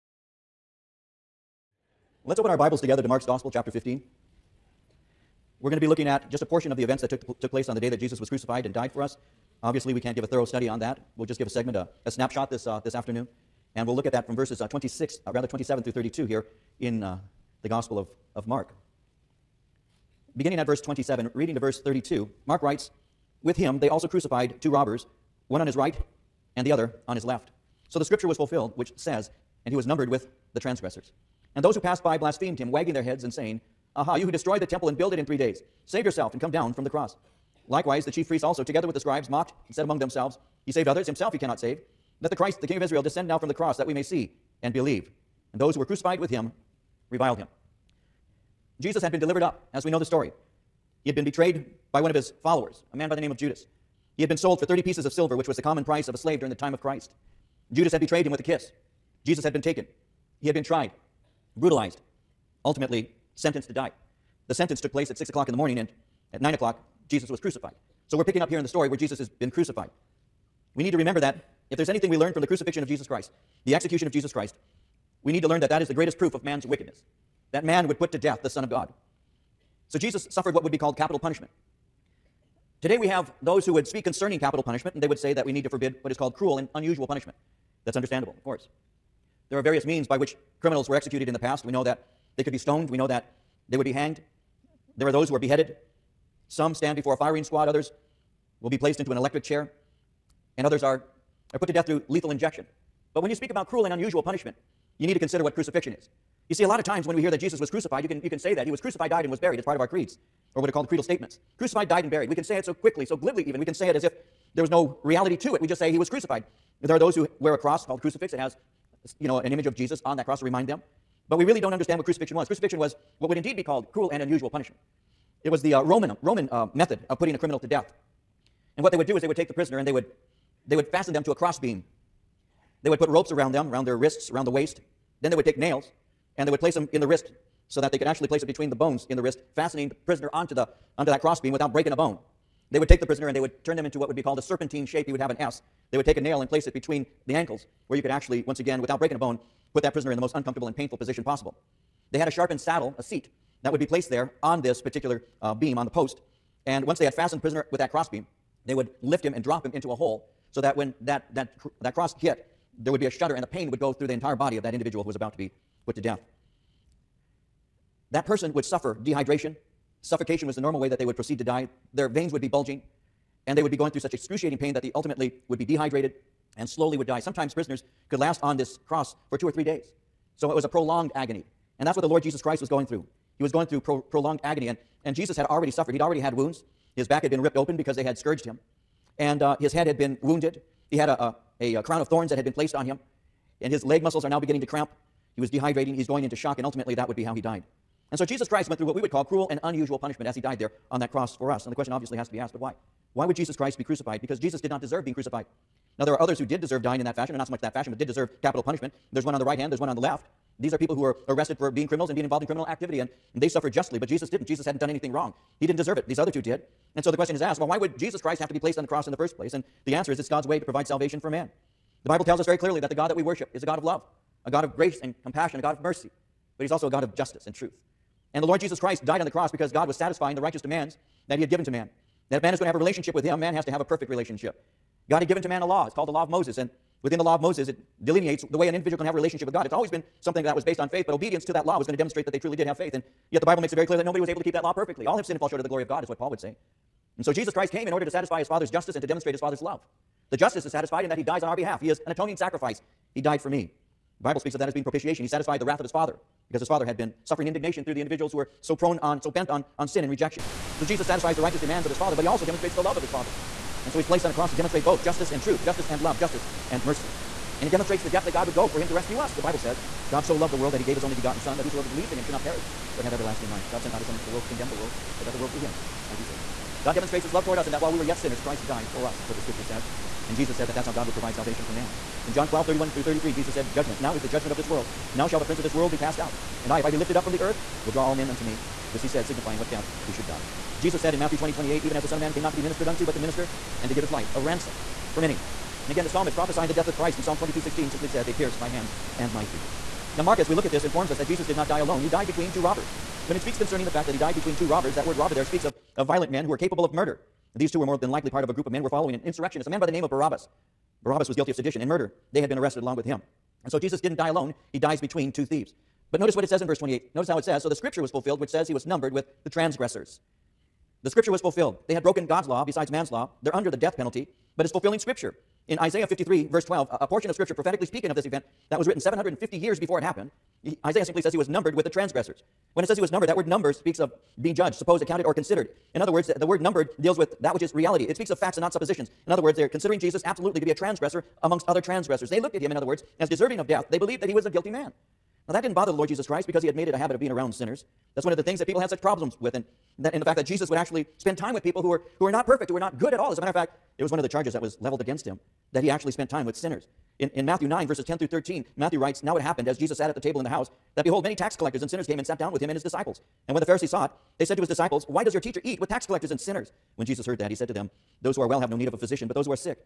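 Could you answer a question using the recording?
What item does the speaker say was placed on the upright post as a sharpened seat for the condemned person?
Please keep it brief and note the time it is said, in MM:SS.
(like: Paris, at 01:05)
saddle, at 02:32.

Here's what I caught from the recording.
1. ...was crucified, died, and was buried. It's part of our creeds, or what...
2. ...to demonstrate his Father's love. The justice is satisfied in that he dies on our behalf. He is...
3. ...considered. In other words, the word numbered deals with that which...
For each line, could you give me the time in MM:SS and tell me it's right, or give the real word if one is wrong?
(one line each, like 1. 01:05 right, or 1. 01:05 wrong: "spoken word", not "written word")
1. 01:48 right
2. 04:09 right
3. 05:35 right.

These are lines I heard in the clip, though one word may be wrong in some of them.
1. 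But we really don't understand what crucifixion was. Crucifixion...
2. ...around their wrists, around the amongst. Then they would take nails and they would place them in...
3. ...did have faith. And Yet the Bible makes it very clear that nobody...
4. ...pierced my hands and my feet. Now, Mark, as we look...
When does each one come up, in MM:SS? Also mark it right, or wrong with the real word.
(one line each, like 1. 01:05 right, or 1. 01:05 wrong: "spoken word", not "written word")
1. 02:01 right
2. 02:13 wrong: "waist", not "amongst"
3. 04:02 right
4. 04:58 right.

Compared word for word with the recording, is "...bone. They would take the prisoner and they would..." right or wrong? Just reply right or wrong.
right.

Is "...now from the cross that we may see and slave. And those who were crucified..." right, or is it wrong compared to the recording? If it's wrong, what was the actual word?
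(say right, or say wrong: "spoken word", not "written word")
wrong: "believe", not "slave".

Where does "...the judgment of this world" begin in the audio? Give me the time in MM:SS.
04:44.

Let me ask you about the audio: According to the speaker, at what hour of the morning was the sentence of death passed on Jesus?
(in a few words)
6 o'clock.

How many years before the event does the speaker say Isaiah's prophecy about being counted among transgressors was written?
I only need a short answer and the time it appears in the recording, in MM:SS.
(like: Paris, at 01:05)
750, at 05:29.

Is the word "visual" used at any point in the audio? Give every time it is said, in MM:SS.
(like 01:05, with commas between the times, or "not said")
not said.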